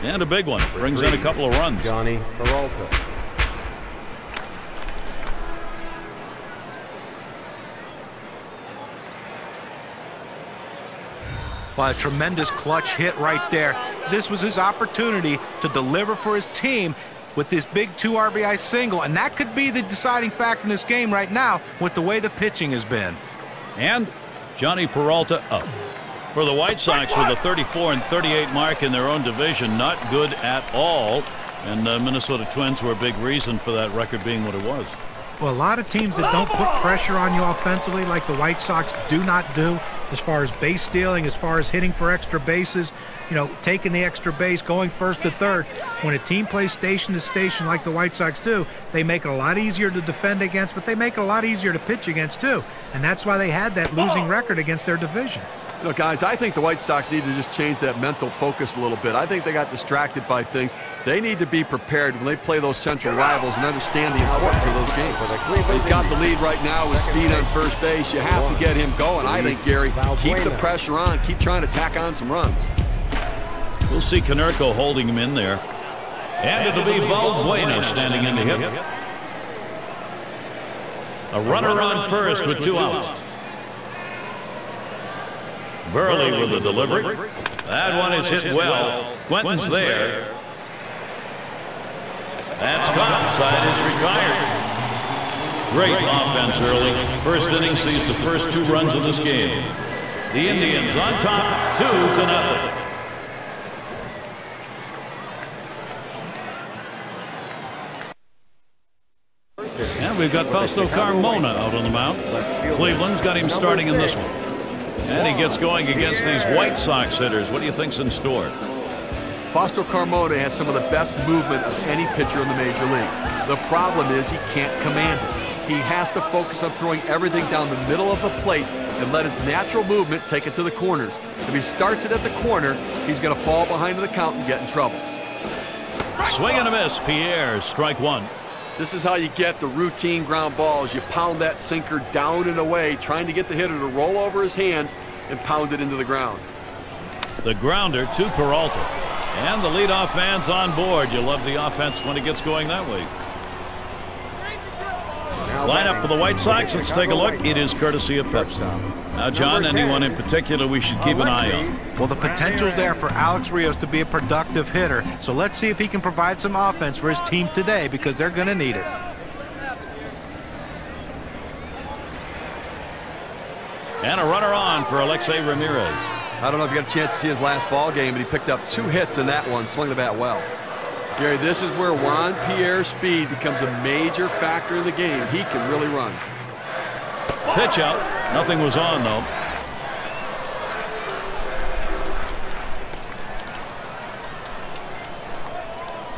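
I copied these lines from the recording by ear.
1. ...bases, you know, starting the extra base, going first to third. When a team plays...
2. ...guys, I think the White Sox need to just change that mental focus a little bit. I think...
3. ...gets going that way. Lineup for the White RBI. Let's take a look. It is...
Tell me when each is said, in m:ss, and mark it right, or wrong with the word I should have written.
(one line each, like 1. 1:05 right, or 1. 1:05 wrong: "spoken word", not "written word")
1. 0:42 wrong: "taking", not "starting"
2. 0:55 right
3. 2:32 wrong: "Sox", not "RBI".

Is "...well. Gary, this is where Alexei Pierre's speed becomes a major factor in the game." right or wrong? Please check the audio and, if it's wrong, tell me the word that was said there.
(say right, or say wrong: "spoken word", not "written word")
wrong: "Juan", not "Alexei".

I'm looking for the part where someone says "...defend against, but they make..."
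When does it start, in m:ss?
0:50.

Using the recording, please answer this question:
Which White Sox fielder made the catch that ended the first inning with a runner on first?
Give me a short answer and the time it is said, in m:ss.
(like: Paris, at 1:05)
Quentin, at 1:29.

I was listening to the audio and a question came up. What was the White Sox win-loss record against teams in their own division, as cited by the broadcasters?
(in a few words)
34-38.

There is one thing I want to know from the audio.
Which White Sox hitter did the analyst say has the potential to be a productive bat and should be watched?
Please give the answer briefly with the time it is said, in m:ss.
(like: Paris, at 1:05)
Alex Rios, at 2:43.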